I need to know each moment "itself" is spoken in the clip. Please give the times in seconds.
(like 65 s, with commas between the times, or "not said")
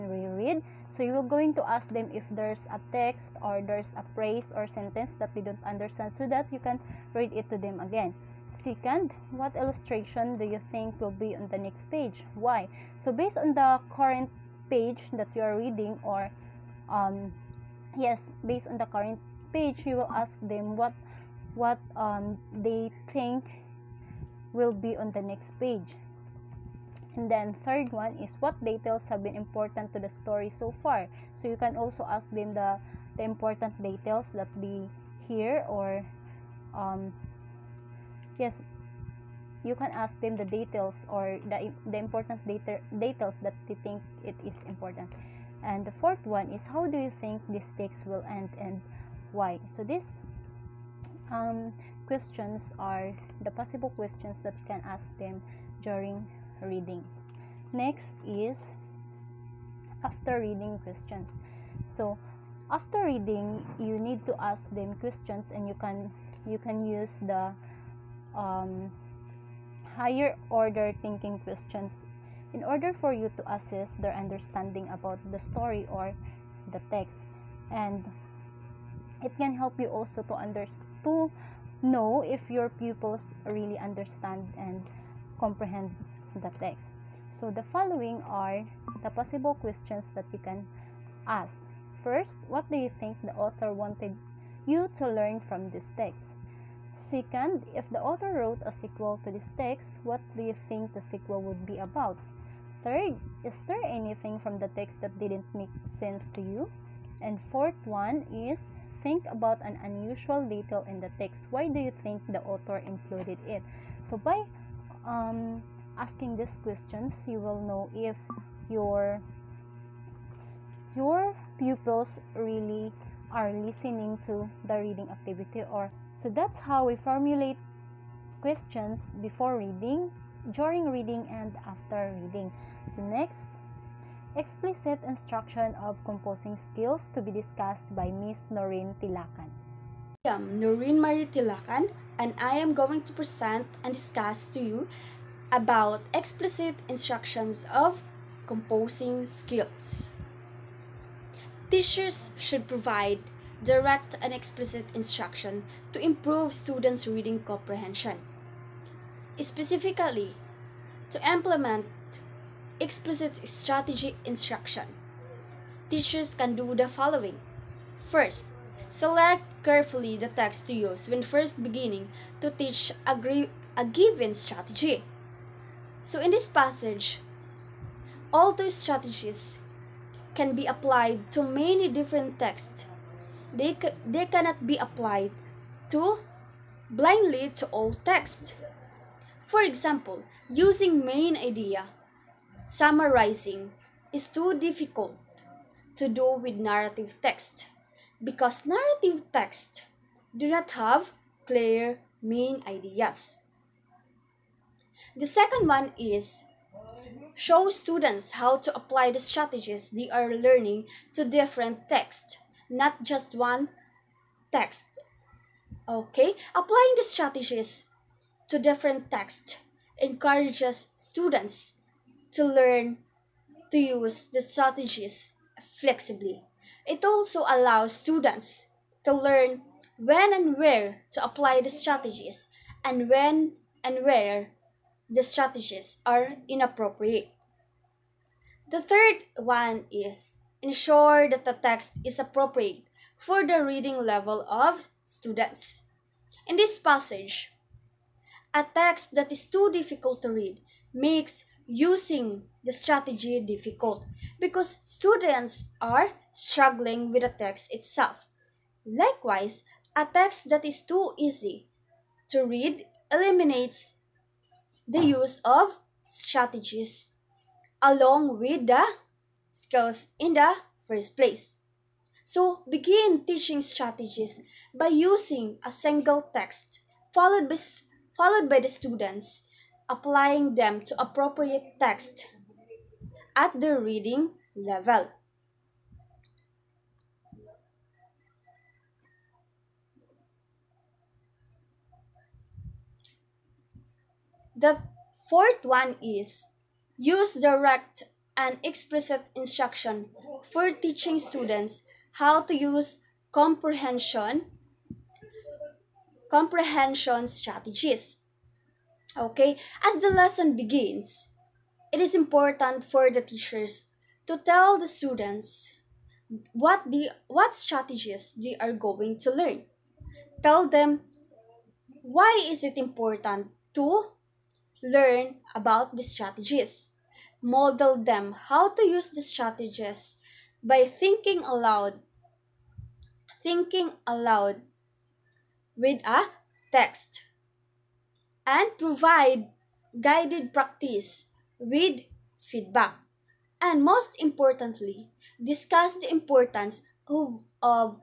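257 s.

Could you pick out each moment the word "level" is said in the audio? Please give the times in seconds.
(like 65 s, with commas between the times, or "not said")
244 s, 284 s.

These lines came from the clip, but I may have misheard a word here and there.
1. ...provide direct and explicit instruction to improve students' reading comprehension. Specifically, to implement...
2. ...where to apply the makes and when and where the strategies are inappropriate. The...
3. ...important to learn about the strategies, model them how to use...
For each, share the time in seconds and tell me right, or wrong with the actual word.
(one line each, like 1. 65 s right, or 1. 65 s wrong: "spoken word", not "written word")
1. 152 s right
2. 230 s wrong: "strategies", not "makes"
3. 322 s right.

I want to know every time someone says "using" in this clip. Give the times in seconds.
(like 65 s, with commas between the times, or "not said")
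190 s, 251 s, 274 s.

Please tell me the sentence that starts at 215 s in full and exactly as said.
Okay, applying the strategies to different texts encourages students to learn to use the strategies flexibly.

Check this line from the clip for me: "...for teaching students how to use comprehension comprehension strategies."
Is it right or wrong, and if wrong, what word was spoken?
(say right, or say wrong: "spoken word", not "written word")
right.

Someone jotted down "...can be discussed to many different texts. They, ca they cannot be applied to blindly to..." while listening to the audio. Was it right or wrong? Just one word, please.
wrong.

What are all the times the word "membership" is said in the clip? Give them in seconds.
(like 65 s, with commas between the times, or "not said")
not said.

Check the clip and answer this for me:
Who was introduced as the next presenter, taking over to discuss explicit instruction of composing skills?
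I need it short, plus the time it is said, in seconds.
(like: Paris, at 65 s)
Noreen Marie Tilakan, at 140 s.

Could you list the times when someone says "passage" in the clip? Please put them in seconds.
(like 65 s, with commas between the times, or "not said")
176 s, 246 s.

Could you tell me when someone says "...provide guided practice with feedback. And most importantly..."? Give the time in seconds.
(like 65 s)
338 s.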